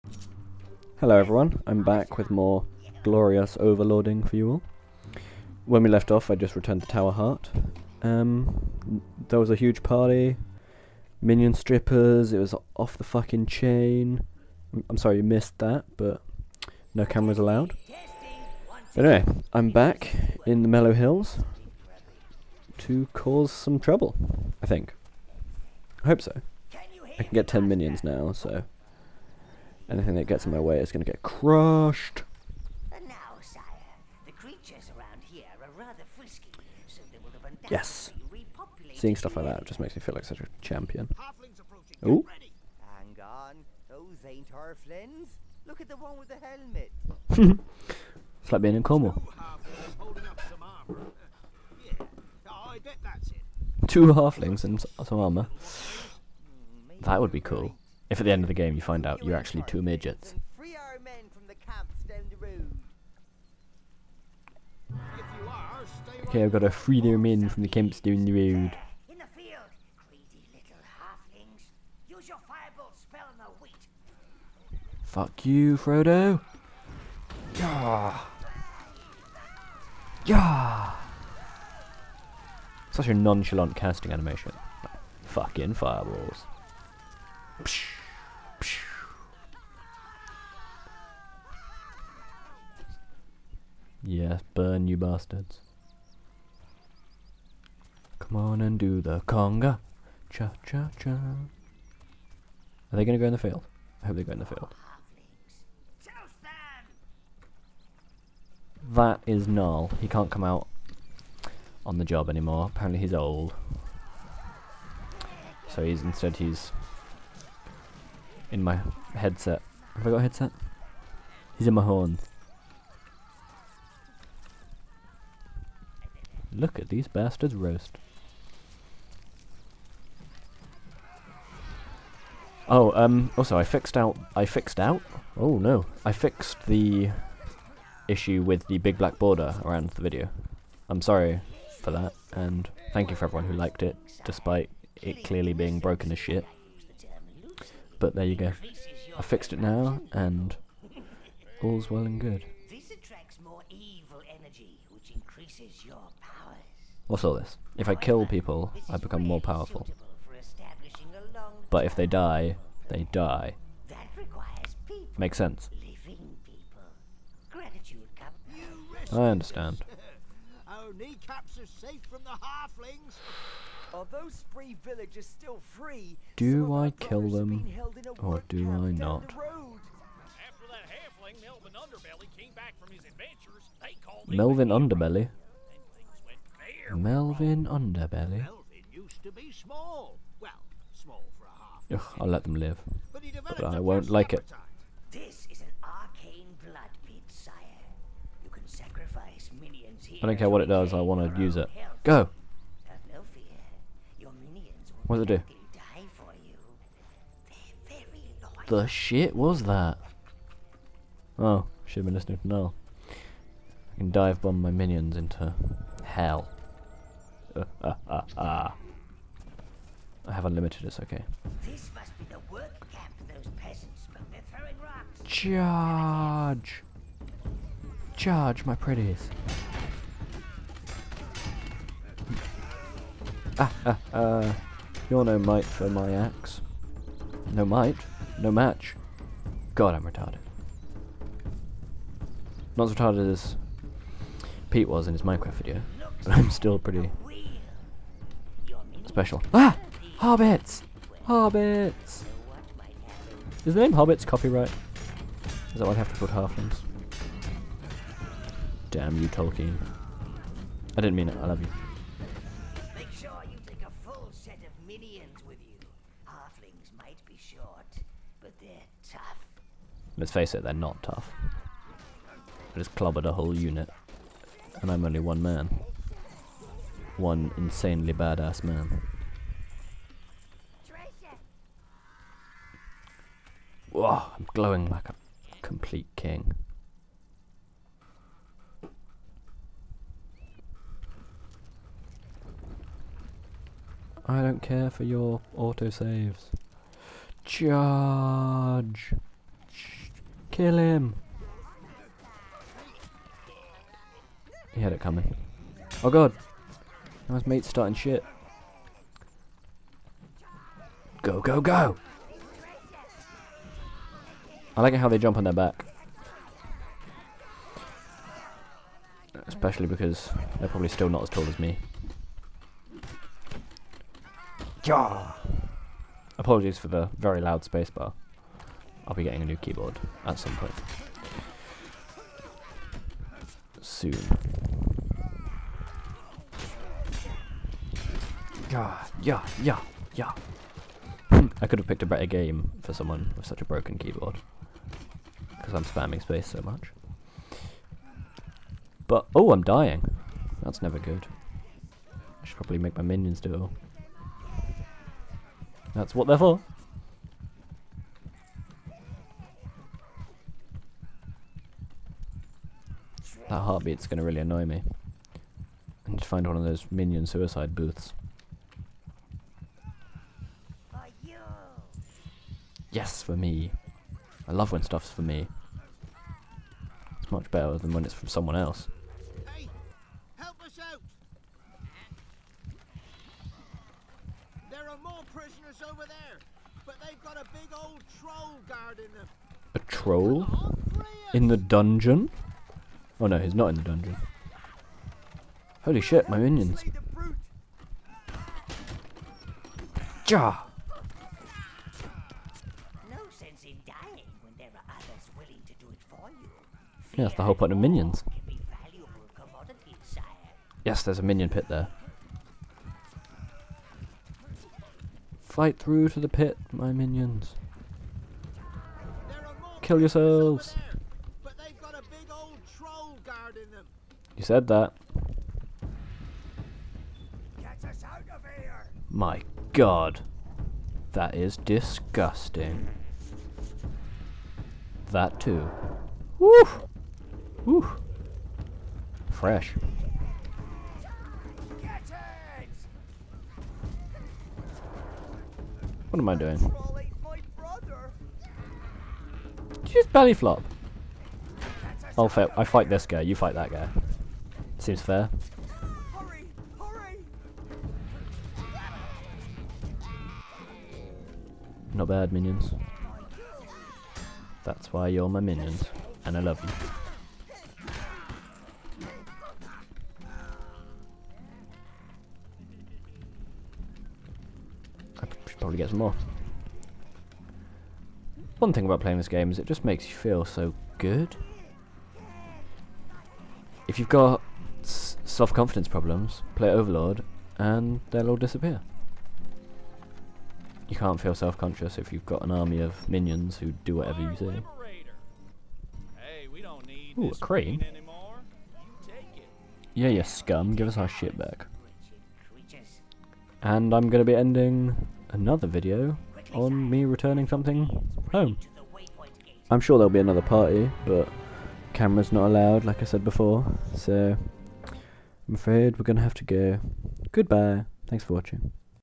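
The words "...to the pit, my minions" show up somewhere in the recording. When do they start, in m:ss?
6:56.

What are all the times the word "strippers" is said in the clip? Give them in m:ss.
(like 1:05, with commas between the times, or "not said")
0:11.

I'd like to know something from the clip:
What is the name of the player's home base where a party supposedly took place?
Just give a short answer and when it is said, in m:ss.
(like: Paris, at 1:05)
Tower Heart, at 0:06.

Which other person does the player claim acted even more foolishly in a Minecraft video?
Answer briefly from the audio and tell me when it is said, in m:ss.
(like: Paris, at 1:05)
Pete, at 4:04.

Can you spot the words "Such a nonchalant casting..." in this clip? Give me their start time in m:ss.
1:22.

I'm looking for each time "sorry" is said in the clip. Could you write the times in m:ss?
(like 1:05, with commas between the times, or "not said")
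0:14, 2:21.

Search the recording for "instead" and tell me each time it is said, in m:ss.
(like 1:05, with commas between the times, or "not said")
1:56.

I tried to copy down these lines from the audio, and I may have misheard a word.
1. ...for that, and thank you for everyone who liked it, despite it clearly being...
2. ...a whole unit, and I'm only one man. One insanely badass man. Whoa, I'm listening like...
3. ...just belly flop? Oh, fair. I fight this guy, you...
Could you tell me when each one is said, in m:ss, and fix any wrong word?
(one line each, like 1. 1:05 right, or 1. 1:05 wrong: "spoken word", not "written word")
1. 2:21 right
2. 4:33 wrong: "glowing", not "listening"
3. 7:29 right.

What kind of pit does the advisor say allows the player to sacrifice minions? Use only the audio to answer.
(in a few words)
Arcane blood pit.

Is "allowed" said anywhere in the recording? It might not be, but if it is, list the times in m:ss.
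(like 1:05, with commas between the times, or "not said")
0:17, 8:32.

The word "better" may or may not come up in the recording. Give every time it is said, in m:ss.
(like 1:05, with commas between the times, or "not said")
5:42, 6:17.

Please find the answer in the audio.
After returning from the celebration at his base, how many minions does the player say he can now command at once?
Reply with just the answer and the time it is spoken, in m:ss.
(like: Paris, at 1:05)
10, at 0:27.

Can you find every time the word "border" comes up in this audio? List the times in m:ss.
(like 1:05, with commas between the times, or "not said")
2:19.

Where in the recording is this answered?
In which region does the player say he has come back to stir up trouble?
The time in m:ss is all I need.
0:20.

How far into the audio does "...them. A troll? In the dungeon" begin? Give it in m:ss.
6:29.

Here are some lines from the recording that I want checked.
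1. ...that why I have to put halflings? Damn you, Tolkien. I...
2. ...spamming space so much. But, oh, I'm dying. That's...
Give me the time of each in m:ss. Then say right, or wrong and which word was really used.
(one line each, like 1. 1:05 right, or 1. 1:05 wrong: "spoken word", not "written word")
1. 4:15 right
2. 5:45 right.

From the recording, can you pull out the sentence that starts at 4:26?
Halflings might be short, but they're tough.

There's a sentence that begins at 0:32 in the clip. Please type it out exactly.
And now, sire, the creatures around here are rather frisky, so they will have yes.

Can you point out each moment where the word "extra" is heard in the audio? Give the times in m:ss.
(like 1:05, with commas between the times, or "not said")
not said.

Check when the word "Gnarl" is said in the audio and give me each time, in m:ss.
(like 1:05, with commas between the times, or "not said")
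1:49, 3:32.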